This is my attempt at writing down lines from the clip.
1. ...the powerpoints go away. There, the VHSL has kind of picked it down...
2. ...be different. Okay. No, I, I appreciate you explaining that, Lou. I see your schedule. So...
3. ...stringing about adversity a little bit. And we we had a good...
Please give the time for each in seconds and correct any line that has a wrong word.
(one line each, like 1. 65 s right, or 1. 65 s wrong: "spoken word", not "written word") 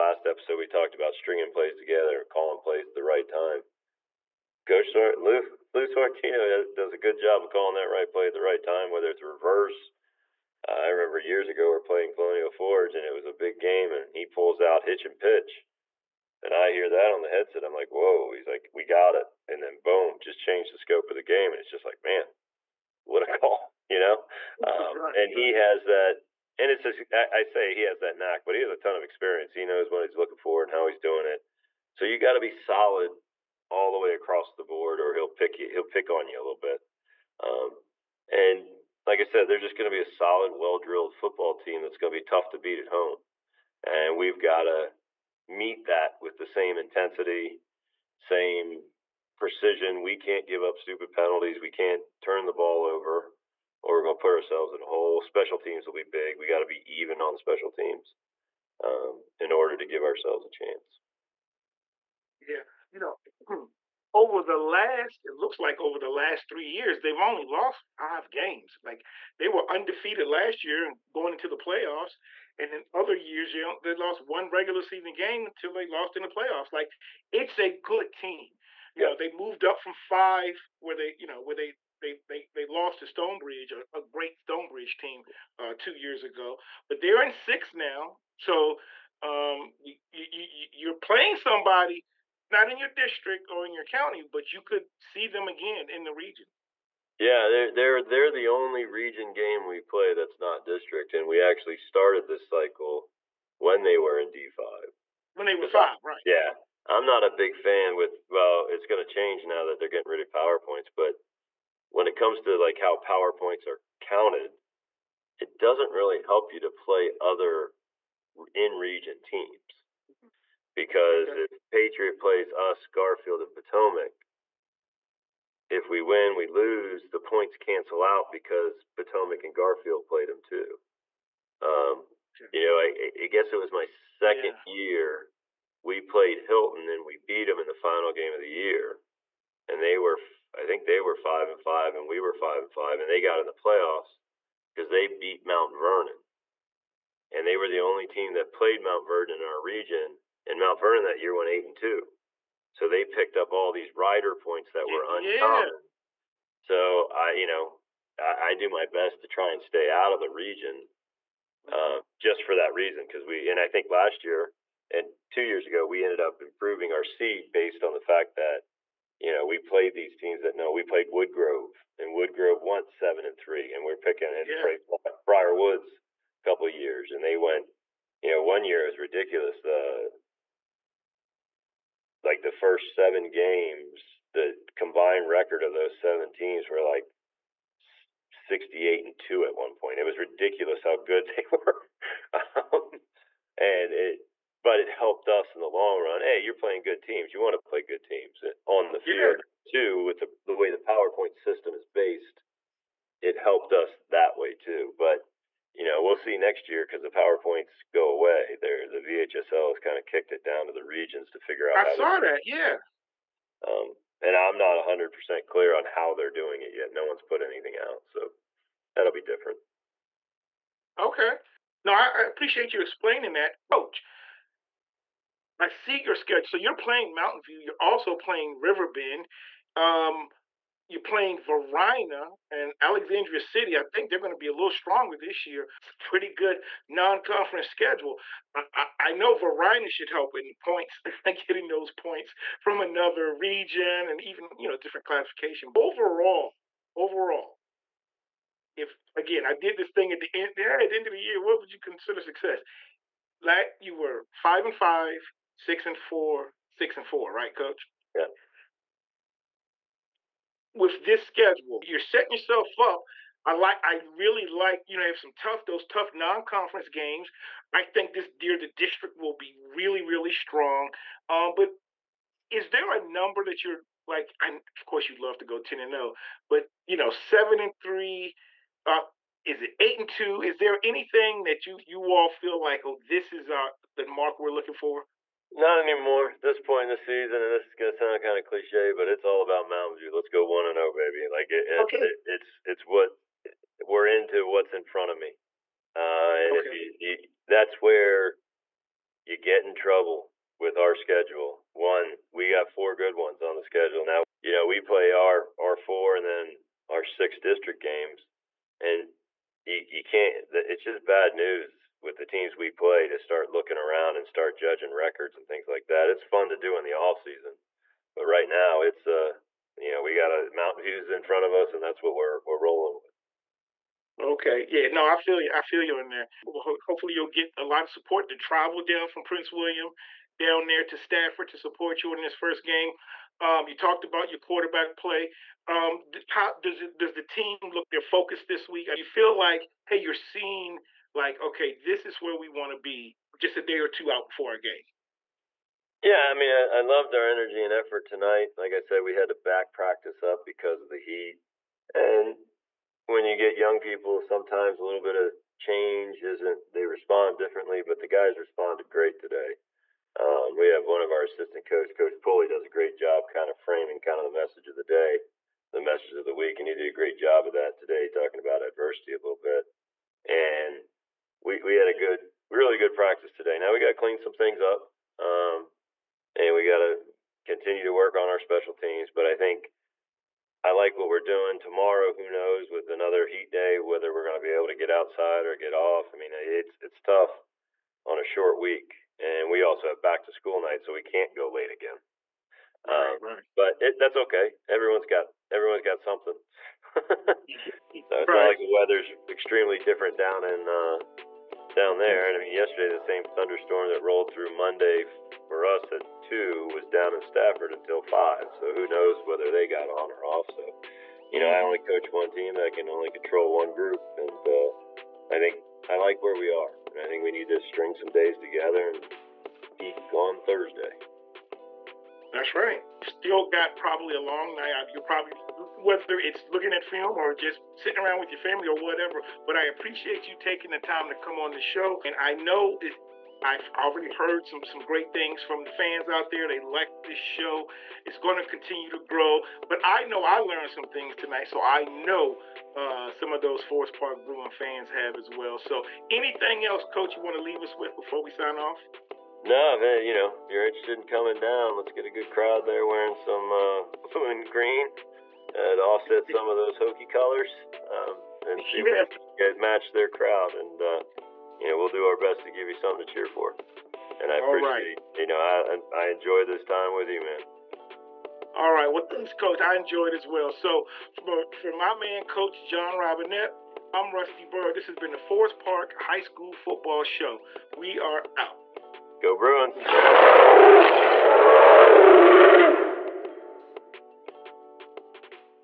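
1. 207 s wrong: "kicked", not "picked"
2. 219 s wrong: "Coach", not "Lou"
3. 368 s wrong: "talking", not "stringing".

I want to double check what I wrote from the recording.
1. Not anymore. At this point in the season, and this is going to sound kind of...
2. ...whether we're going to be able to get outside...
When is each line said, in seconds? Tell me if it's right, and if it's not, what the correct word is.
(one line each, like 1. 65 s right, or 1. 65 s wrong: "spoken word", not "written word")
1. 285 s right
2. 383 s right.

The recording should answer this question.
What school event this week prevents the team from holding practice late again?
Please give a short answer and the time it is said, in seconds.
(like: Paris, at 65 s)
back to school night, at 390 s.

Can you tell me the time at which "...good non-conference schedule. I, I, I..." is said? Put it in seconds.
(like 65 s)
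236 s.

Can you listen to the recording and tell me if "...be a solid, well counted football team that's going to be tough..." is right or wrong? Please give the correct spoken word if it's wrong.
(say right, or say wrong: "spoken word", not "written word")
wrong: "drilled", not "counted".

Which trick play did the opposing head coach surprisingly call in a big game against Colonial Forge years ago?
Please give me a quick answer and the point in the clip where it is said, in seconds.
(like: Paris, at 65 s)
hitch and pitch, at 14 s.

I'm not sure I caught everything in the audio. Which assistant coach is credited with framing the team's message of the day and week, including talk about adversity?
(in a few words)
Coach Pulley.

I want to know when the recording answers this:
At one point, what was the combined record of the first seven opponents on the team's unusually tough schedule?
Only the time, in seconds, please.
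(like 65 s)
188 s.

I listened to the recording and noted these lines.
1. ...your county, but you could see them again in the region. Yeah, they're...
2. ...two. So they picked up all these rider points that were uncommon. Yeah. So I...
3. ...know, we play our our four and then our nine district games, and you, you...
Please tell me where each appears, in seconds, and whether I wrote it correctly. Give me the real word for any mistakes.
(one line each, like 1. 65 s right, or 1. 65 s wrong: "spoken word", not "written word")
1. 93 s right
2. 151 s right
3. 304 s wrong: "six", not "nine".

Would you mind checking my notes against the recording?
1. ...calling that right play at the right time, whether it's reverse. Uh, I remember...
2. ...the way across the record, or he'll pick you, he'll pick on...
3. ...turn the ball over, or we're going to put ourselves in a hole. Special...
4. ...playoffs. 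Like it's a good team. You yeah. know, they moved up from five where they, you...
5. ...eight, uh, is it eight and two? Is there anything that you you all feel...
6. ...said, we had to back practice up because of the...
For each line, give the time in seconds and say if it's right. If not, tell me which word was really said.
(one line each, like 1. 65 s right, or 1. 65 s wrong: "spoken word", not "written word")
1. 7 s right
2. 33 s wrong: "board", not "record"
3. 52 s right
4. 76 s right
5. 277 s wrong: "three", not "eight"
6. 348 s right.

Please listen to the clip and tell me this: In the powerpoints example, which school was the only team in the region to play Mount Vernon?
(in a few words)
Hilton.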